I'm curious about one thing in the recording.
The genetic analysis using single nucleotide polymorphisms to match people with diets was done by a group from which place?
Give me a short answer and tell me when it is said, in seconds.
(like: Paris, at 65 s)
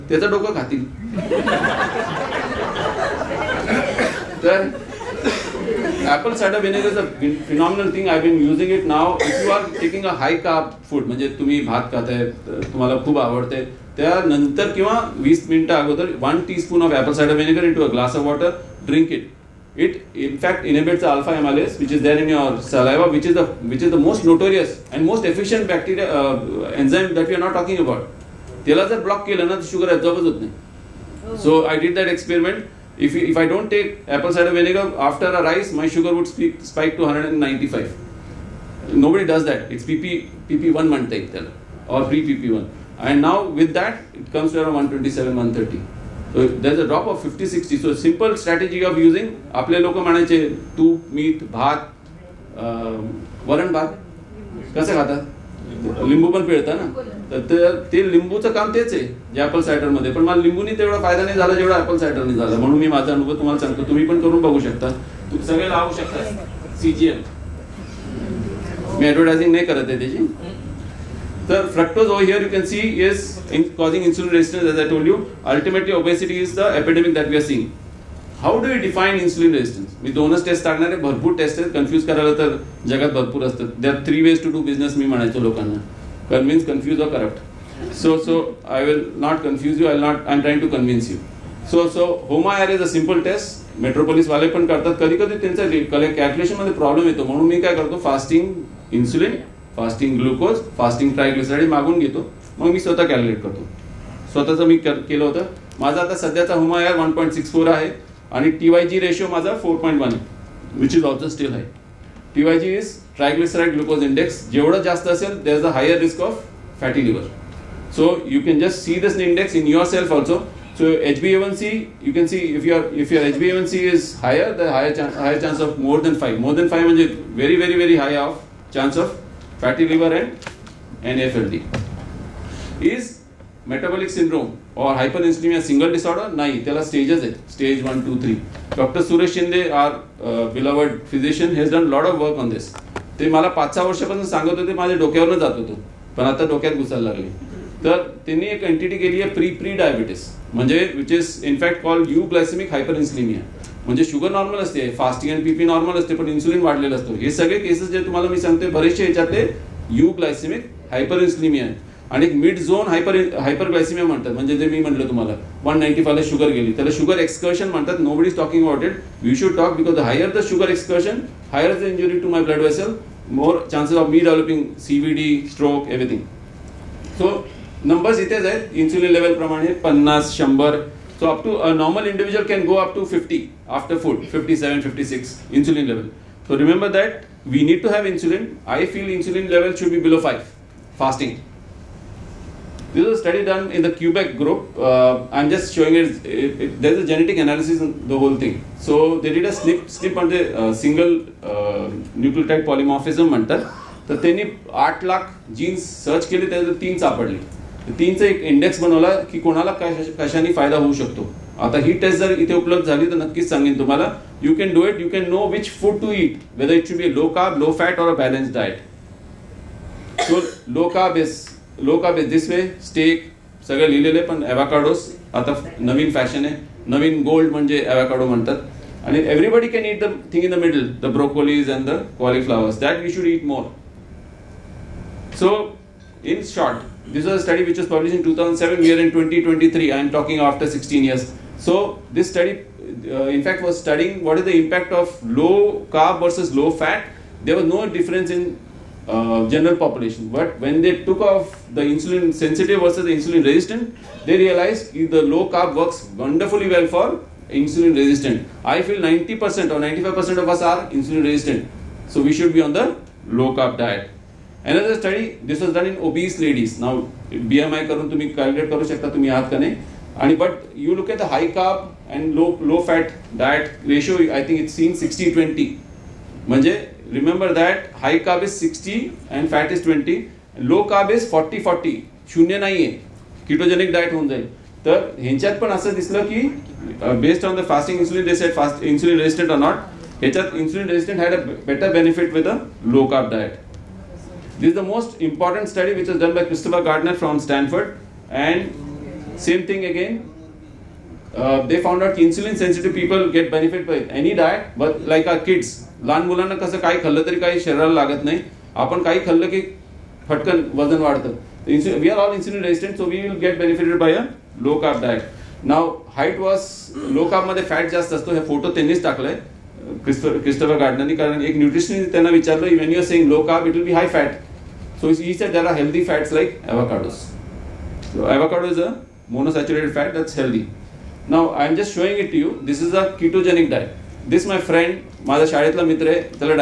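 Quebec, at 193 s.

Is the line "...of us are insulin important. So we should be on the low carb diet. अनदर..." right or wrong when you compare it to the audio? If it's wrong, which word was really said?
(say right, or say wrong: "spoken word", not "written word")
wrong: "resistant", not "important".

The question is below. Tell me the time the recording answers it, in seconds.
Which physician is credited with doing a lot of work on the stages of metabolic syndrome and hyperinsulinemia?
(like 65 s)
138 s.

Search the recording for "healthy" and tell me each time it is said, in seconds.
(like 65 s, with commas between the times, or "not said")
325 s, 330 s.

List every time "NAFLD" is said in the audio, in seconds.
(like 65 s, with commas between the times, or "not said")
131 s.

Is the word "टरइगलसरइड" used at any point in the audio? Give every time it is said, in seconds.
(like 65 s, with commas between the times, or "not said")
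101 s.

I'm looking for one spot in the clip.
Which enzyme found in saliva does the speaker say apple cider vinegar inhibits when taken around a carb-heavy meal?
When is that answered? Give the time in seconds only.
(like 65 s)
21 s.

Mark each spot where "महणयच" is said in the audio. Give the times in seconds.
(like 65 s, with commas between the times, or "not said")
49 s, 85 s.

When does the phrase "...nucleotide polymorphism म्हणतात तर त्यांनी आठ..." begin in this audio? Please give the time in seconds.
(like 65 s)
202 s.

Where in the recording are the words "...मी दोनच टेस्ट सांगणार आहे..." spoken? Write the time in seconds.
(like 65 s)
80 s.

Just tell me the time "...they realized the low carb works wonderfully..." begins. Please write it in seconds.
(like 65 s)
254 s.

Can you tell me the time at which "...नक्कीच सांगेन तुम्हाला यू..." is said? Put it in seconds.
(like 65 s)
213 s.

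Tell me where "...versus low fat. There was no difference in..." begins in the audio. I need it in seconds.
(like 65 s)
246 s.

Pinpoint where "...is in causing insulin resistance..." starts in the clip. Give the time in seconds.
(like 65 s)
73 s.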